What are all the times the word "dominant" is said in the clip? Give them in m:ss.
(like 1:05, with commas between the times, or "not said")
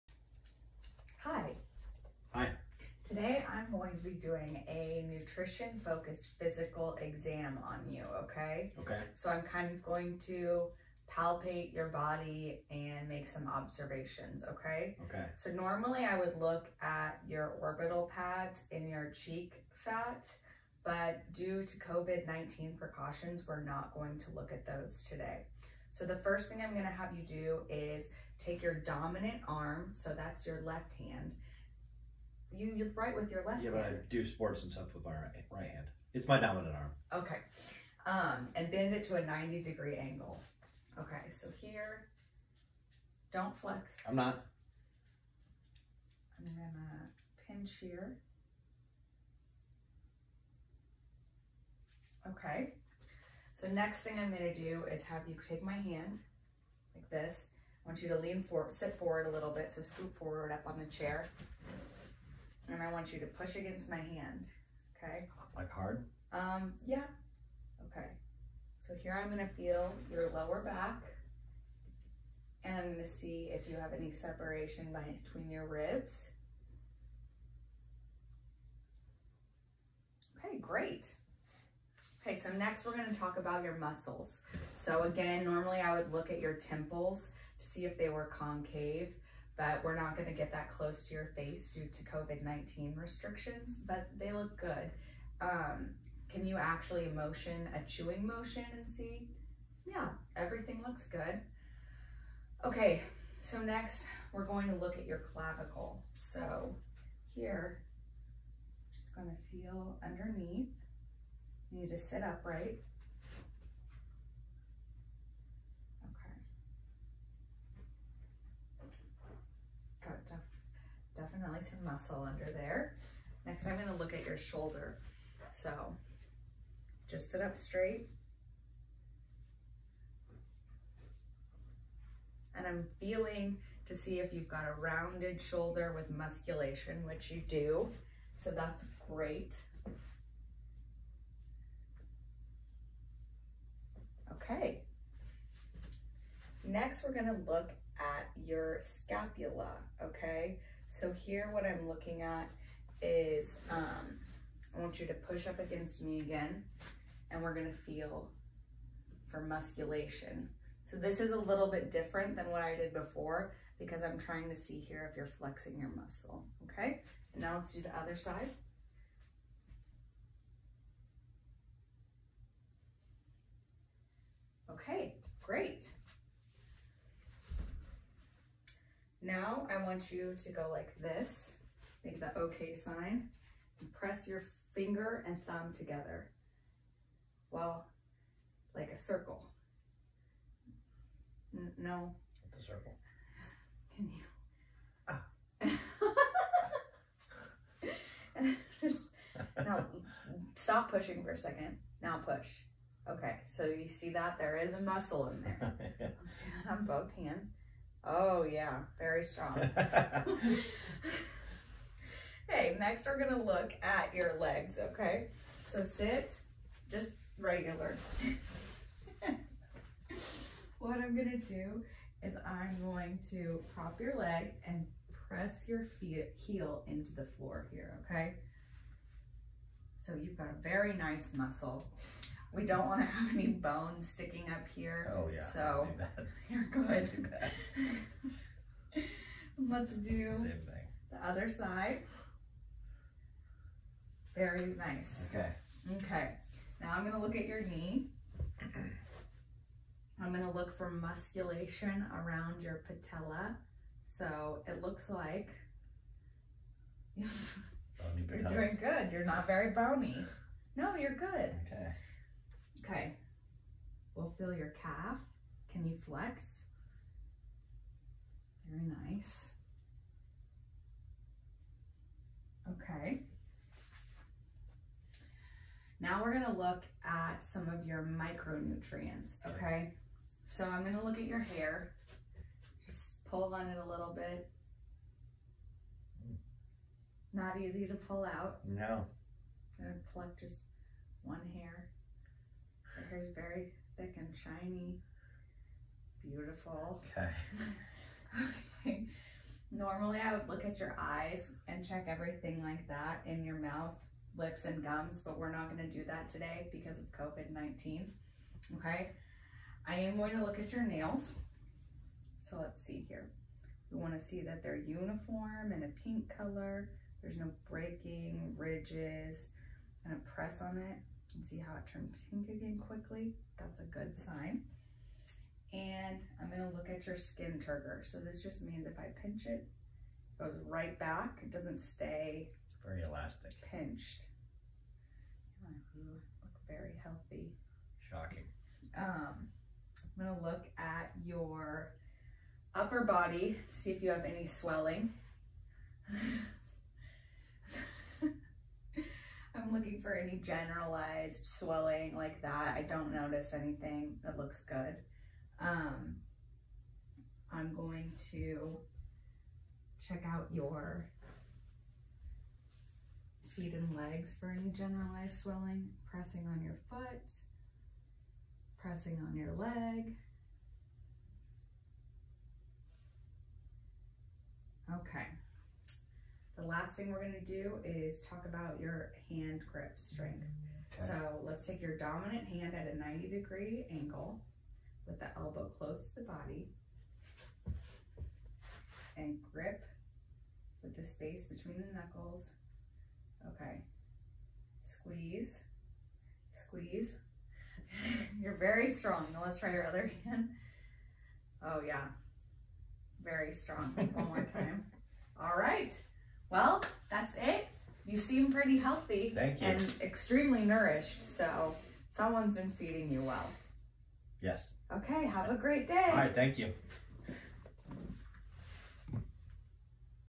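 0:28, 0:36, 6:21.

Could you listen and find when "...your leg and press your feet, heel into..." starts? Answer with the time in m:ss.
3:44.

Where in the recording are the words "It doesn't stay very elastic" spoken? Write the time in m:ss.
5:31.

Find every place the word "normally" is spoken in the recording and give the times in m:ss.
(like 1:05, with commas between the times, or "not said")
0:15, 1:25, 4:59.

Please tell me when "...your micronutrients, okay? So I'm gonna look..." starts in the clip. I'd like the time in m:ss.
4:37.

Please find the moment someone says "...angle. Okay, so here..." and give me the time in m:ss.
0:39.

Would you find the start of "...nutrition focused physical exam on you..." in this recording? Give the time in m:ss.
0:05.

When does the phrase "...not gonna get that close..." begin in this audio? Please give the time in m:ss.
1:29.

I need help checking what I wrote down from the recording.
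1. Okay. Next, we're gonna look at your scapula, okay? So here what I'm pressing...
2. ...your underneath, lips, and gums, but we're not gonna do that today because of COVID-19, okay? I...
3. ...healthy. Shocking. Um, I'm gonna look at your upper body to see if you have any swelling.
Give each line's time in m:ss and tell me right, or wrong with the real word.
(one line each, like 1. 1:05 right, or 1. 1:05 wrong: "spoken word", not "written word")
1. 2:24 wrong: "looking", not "pressing"
2. 5:03 wrong: "mouth", not "underneath"
3. 5:37 right.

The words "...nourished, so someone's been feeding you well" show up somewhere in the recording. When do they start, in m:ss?
6:50.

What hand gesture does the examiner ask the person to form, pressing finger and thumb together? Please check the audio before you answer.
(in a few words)
Okay sign.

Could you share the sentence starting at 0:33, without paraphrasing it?
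Yeah, but I do sports and stuff with my right, right hand.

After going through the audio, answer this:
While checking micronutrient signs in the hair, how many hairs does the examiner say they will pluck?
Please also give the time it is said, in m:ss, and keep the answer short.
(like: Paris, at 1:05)
1, at 4:50.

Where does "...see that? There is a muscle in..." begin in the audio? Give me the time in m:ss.
3:23.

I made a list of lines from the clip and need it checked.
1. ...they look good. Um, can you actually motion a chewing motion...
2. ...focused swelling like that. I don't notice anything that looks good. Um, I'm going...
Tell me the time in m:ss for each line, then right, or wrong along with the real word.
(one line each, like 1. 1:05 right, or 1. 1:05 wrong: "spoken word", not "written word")
1. 1:34 right
2. 5:50 wrong: "generalized", not "focused".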